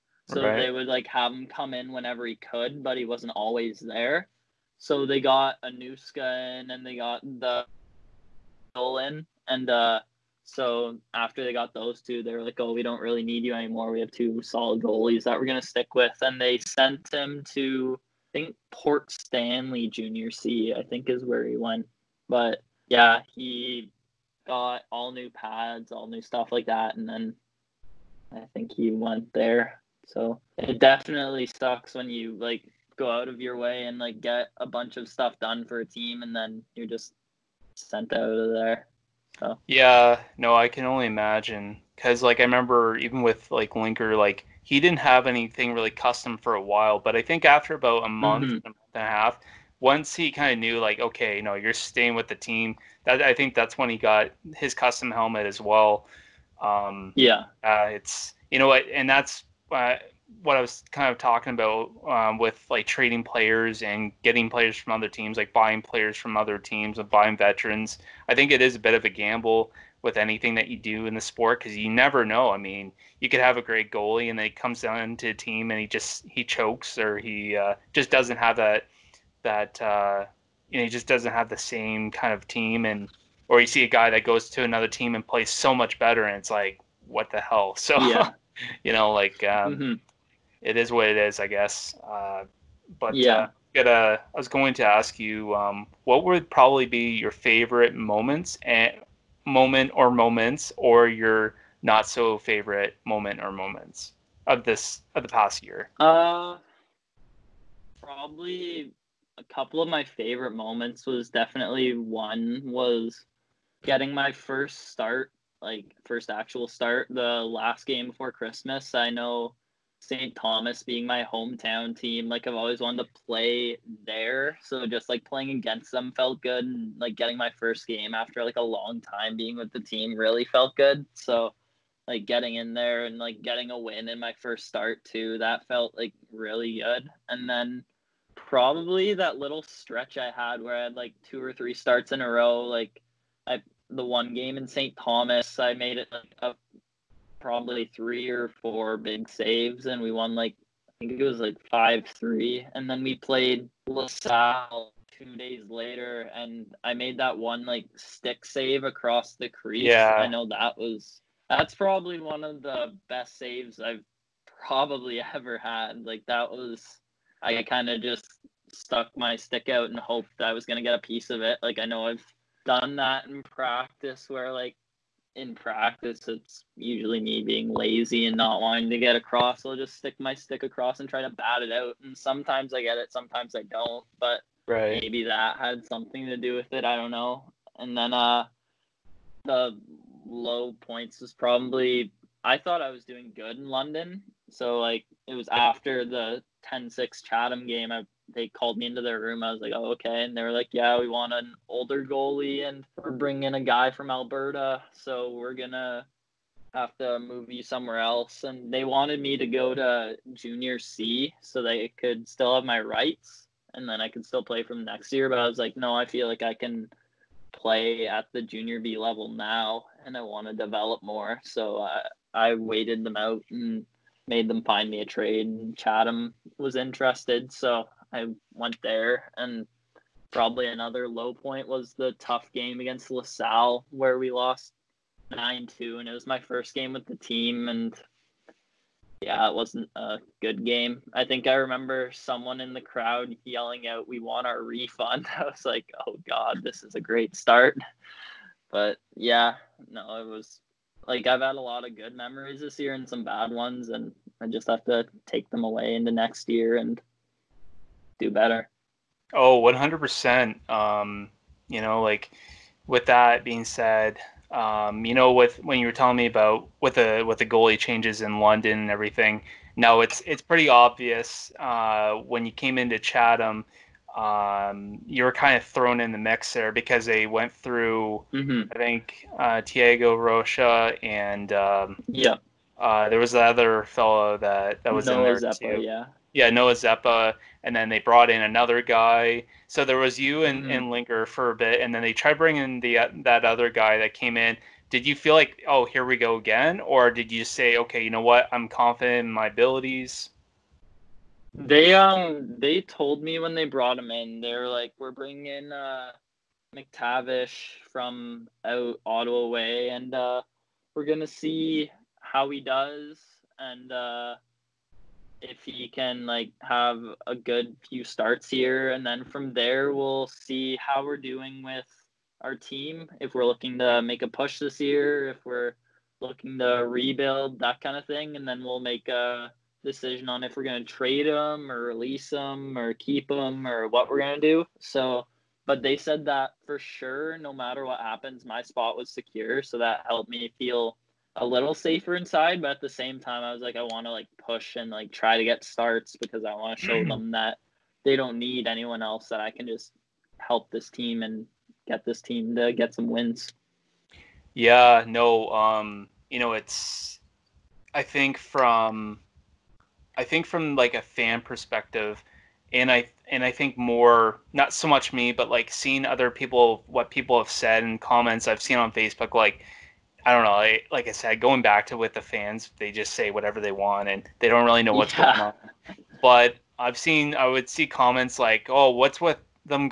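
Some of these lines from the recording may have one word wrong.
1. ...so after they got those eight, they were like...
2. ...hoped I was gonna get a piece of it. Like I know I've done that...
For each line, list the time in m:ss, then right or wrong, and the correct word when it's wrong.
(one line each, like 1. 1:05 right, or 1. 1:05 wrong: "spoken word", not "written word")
1. 0:10 wrong: "two", not "eight"
2. 2:49 right.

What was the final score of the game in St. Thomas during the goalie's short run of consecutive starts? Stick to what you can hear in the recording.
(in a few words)
5-3.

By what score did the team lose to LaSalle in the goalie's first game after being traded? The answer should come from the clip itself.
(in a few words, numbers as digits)
9-2.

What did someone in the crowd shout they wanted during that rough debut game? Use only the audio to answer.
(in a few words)
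Our refund.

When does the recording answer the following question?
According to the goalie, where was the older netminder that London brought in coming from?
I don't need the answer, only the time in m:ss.
3:24.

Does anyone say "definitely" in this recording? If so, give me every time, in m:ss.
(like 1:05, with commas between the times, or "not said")
0:30, 1:51.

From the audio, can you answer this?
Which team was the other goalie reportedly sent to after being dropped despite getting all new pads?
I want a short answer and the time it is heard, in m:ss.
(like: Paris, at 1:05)
Port Stanley Junior C, at 0:18.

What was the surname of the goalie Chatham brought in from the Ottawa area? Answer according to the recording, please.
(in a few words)
McTavish.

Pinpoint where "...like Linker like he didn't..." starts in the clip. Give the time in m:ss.
0:43.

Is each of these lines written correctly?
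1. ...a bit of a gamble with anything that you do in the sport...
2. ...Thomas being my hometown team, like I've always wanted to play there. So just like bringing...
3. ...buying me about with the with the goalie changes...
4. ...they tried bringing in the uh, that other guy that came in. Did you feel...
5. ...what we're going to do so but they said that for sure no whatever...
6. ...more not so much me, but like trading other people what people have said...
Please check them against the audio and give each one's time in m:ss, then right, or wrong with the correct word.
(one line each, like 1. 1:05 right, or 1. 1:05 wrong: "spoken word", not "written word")
1. 1:08 right
2. 2:00 wrong: "playing", not "bringing"
3. 4:25 wrong: "telling", not "buying"
4. 4:52 right
5. 5:33 wrong: "matter", not "whatever"
6. 6:03 wrong: "seeing", not "trading".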